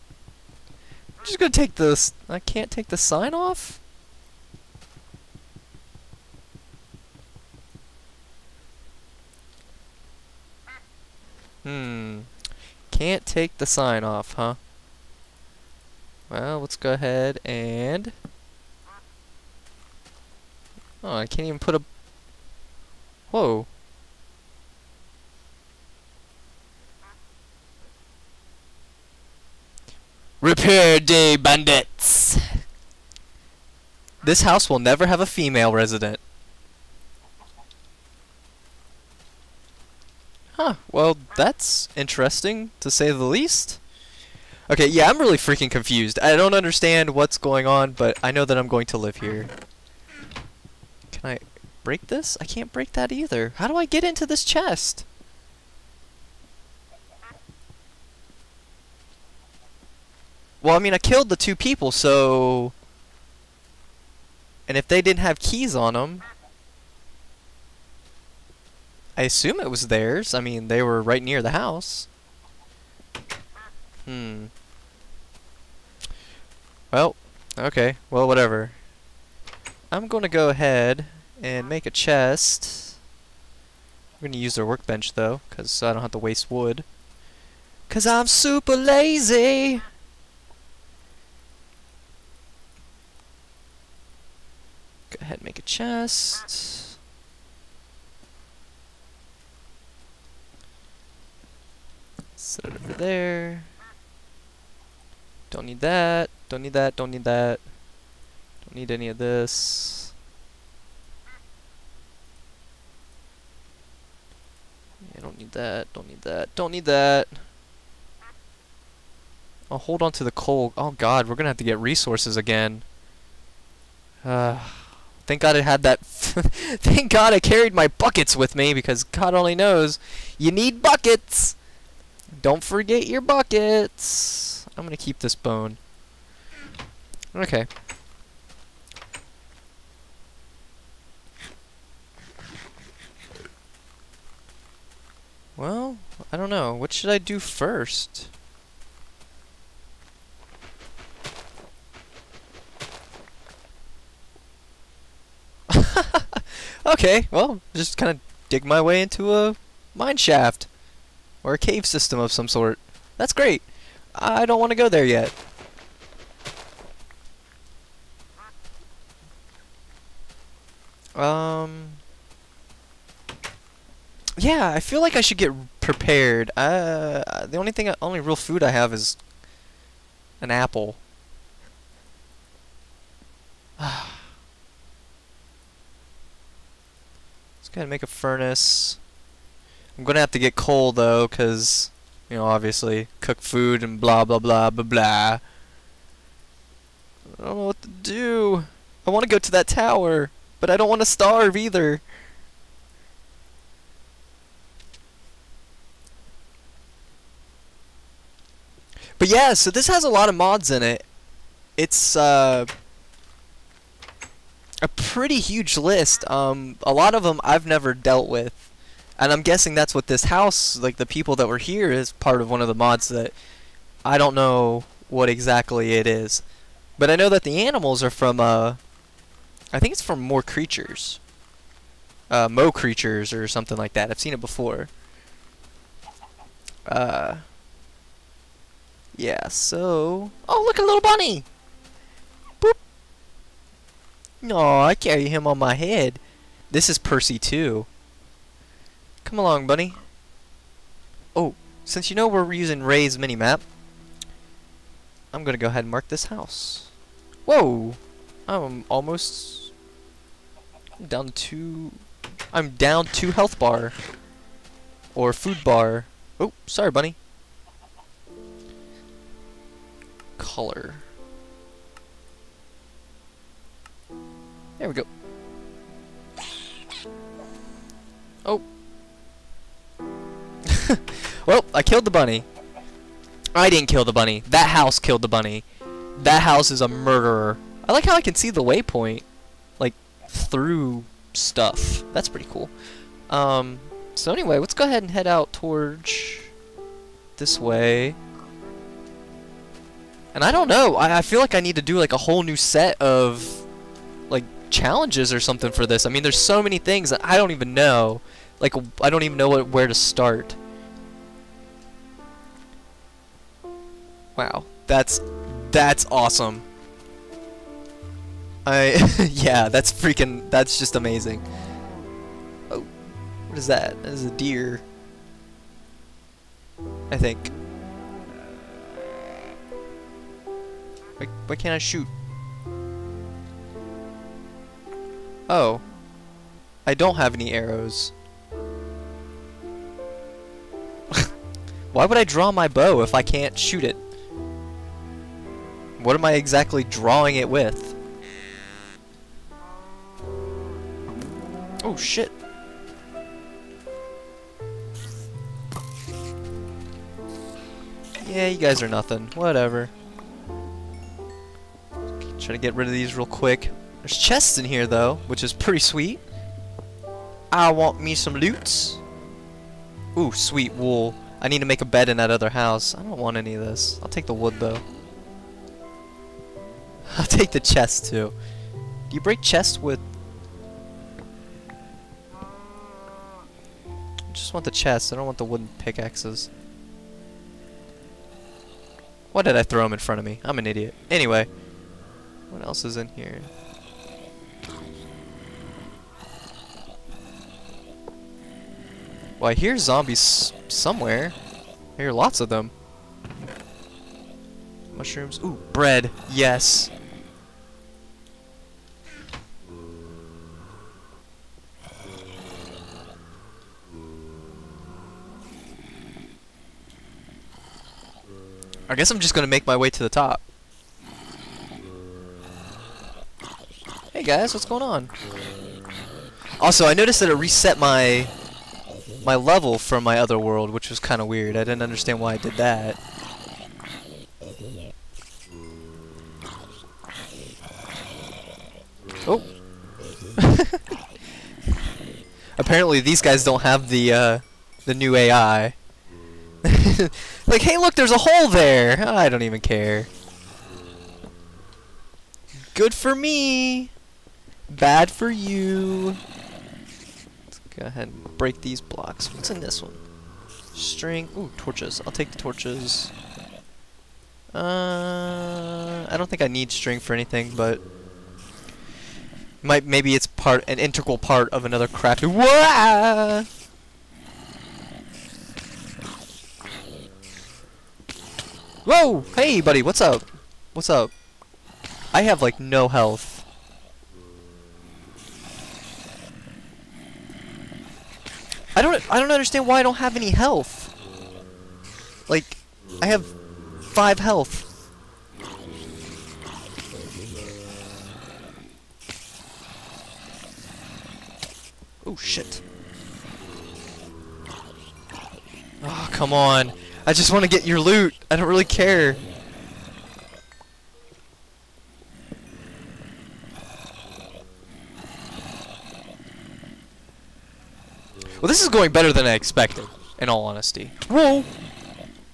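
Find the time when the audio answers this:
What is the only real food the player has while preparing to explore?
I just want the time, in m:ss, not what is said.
3:00.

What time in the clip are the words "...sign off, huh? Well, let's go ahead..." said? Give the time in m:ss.
0:13.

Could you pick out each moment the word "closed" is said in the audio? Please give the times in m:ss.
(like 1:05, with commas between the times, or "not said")
not said.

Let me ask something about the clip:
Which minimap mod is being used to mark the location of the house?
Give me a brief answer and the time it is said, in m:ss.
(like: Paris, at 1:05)
Rei's minimap, at 4:12.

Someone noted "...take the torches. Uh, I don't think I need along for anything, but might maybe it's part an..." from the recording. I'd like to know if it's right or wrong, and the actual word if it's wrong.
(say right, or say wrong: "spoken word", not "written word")
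wrong: "string", not "along".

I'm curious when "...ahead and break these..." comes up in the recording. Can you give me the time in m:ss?
7:37.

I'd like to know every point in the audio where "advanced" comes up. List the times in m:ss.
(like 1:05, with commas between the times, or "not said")
not said.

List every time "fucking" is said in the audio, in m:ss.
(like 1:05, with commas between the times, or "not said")
not said.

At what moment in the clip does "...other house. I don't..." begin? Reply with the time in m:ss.
6:12.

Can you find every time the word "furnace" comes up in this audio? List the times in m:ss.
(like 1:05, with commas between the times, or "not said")
3:08.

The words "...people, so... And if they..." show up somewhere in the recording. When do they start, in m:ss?
1:01.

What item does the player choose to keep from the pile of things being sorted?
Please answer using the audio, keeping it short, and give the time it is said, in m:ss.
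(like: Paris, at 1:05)
Bone, at 2:14.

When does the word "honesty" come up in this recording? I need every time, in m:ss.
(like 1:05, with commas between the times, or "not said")
8:40.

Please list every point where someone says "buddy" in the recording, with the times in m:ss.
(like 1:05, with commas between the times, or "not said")
7:59.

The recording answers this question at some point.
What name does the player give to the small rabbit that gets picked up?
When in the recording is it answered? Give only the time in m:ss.
4:06.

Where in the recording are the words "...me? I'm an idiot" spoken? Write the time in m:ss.
6:30.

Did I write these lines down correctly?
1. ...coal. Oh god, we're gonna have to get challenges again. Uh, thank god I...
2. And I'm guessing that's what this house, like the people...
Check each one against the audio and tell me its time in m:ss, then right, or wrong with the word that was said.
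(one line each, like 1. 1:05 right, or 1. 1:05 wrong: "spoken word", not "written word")
1. 2:00 wrong: "resources", not "challenges"
2. 3:39 right.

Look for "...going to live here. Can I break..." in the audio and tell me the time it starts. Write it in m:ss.
0:48.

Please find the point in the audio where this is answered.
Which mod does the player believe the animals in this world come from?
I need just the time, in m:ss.
3:52.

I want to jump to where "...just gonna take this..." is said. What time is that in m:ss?
0:01.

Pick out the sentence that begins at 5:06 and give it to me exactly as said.
I mean, there's so many things that I don't even know.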